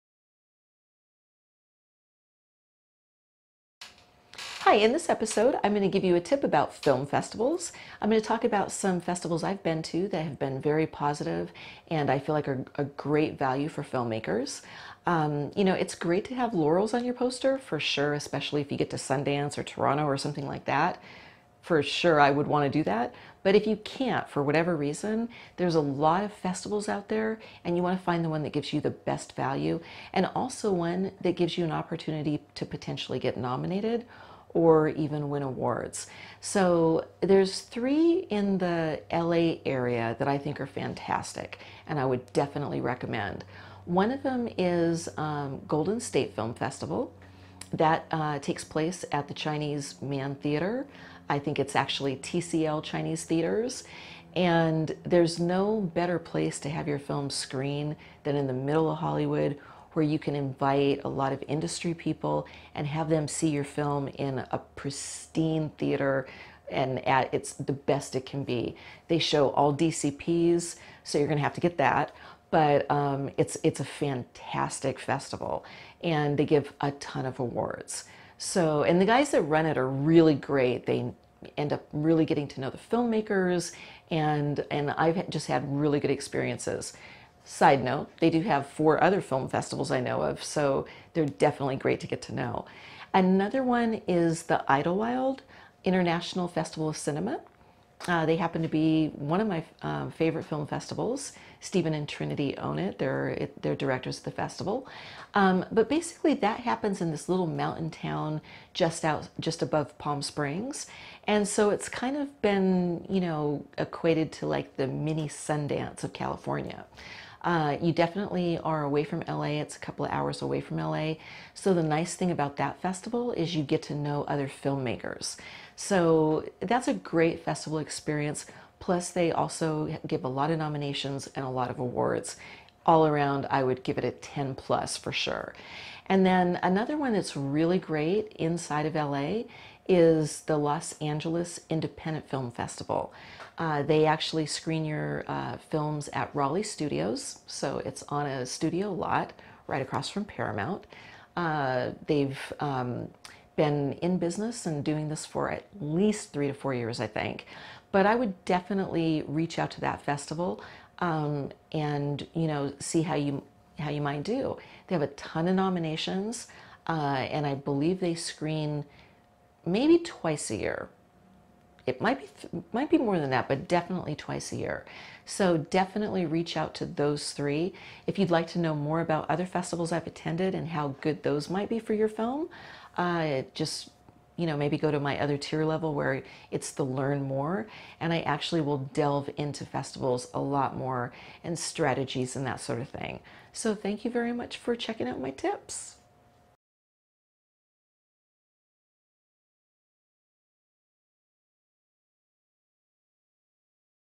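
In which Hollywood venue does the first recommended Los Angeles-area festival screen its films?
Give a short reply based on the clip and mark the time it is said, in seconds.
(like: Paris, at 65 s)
TCL Chinese Theaters, at 52 s.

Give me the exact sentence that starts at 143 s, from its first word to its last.
Uh, they actually screen your uh, films at Raleigh Studios, so it's on a studio lot right across from Paramount.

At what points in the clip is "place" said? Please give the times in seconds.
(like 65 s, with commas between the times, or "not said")
48 s, 56 s.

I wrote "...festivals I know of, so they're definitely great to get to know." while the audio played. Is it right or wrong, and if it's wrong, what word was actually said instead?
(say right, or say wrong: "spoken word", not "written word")
right.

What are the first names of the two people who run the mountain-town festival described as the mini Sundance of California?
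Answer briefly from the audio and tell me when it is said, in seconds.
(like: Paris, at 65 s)
Stephen and Trinity, at 101 s.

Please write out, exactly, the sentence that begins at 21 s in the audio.
For sure, I would want to do that.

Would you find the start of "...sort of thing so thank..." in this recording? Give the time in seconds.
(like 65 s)
192 s.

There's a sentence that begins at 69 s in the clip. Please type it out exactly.
They show all DCPs, so you're going to have to get that.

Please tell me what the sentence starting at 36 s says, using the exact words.
So there's three in the LA area that I think are fantastic and I would definitely recommend.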